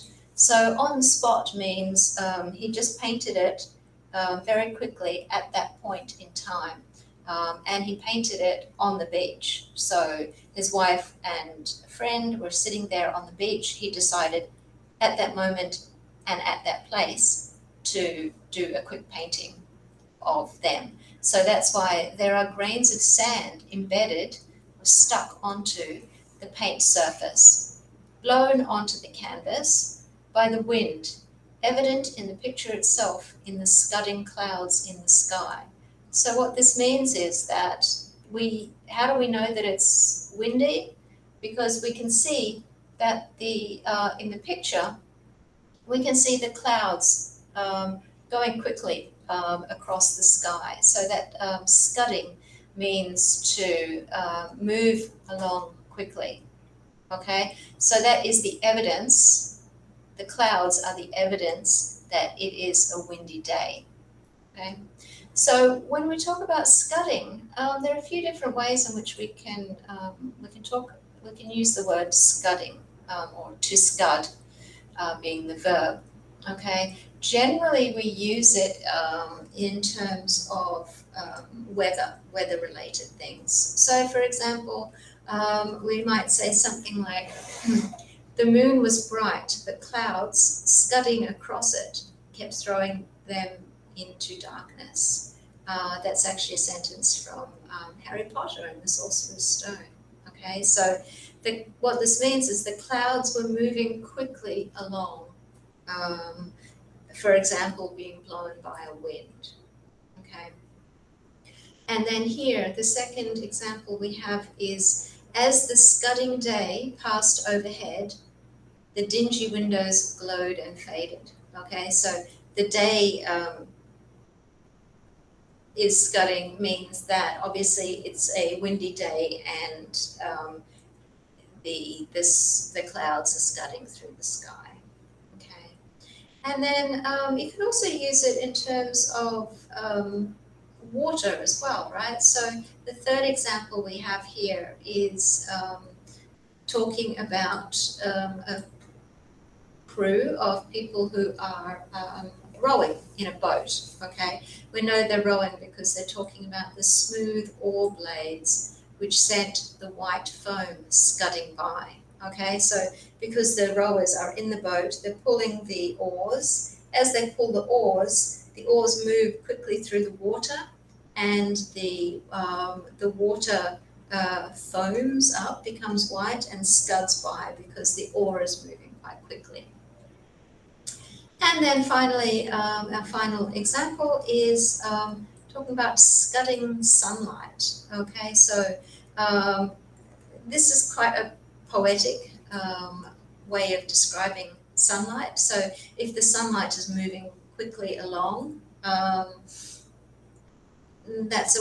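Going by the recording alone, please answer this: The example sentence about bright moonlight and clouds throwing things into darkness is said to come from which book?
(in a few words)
Harry Potter and the Sorcerer's Stone.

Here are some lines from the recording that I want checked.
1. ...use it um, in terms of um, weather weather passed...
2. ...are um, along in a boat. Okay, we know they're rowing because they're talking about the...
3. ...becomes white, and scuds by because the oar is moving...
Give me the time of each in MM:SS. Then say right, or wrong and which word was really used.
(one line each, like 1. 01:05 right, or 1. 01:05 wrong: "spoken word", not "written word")
1. 01:18 wrong: "related", not "passed"
2. 02:31 wrong: "rowing", not "along"
3. 02:55 right.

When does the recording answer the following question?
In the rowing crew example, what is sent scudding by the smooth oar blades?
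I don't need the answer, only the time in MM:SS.
02:39.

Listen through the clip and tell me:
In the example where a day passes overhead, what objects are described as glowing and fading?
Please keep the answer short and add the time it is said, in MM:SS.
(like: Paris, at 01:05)
the dingy windows, at 01:58.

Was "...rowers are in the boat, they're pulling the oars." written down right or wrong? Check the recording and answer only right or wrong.
right.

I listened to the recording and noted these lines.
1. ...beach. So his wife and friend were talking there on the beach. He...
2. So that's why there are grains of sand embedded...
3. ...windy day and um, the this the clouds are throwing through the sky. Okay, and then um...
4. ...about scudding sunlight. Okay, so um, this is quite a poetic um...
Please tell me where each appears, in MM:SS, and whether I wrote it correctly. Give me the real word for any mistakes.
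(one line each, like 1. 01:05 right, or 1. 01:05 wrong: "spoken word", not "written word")
1. 00:09 wrong: "sitting", not "talking"
2. 00:21 right
3. 02:08 wrong: "scudding", not "throwing"
4. 03:05 right.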